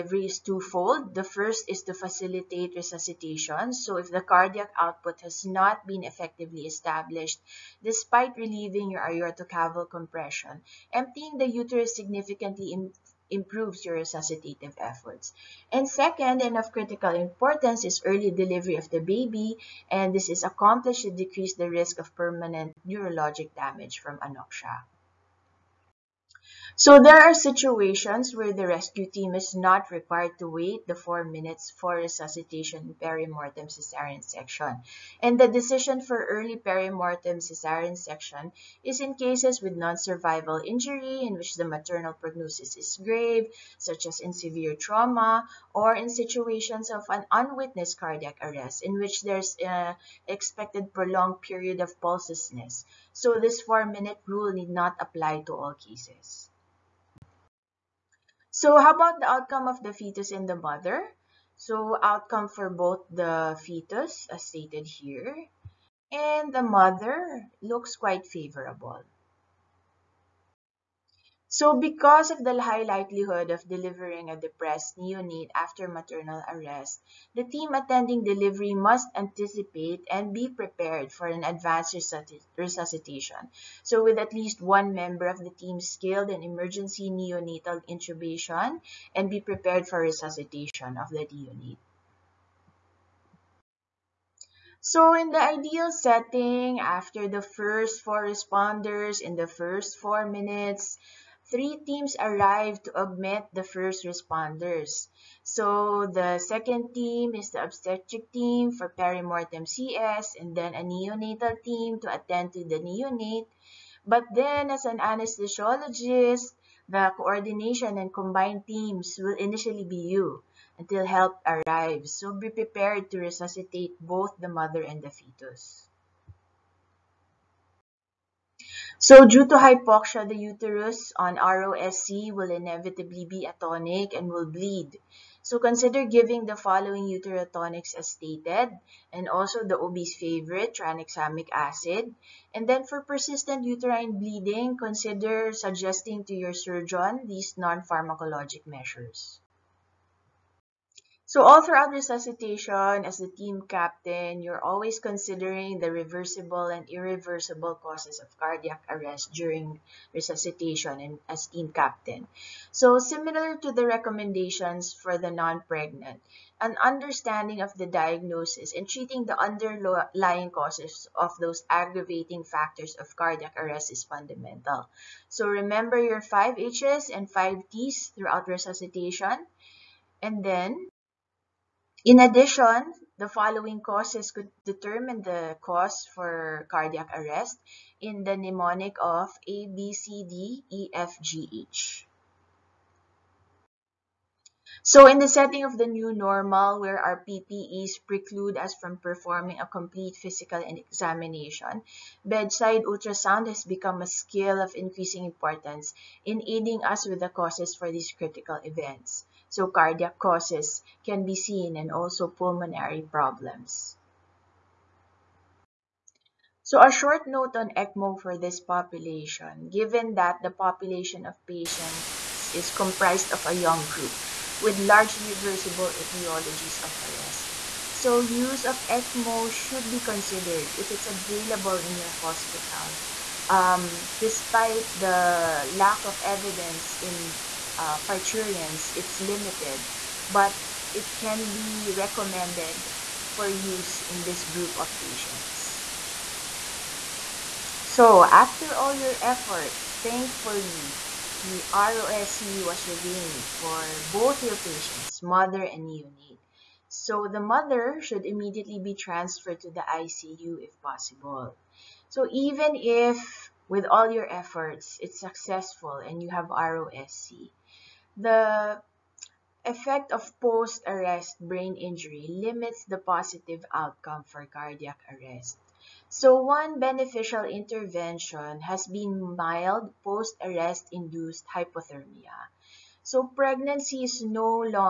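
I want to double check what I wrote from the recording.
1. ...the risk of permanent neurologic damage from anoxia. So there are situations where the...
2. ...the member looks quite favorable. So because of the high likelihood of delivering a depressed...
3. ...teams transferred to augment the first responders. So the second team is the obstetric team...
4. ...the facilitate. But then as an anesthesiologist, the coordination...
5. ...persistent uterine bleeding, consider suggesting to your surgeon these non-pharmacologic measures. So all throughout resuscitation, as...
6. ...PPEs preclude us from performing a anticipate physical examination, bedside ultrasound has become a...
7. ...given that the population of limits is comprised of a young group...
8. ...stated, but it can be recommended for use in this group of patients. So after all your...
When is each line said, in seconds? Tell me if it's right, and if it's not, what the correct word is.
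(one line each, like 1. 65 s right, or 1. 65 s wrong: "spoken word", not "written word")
1. 21 s right
2. 66 s wrong: "mother", not "member"
3. 101 s wrong: "arrived", not "transferred"
4. 112 s wrong: "neonate", not "facilitate"
5. 143 s right
6. 197 s wrong: "complete", not "anticipate"
7. 219 s wrong: "patients", not "limits"
8. 239 s wrong: "limited", not "stated".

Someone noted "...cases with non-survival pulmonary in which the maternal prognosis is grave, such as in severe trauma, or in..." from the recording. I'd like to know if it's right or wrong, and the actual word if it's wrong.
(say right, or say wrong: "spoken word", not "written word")
wrong: "injury", not "pulmonary".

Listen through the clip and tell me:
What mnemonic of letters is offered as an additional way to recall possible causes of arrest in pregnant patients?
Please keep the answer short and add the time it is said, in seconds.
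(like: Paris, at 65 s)
A, B, C, D, E, F, G, H, at 189 s.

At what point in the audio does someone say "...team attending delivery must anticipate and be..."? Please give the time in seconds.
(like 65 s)
77 s.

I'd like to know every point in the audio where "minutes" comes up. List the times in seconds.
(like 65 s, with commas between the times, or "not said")
31 s, 53 s, 100 s.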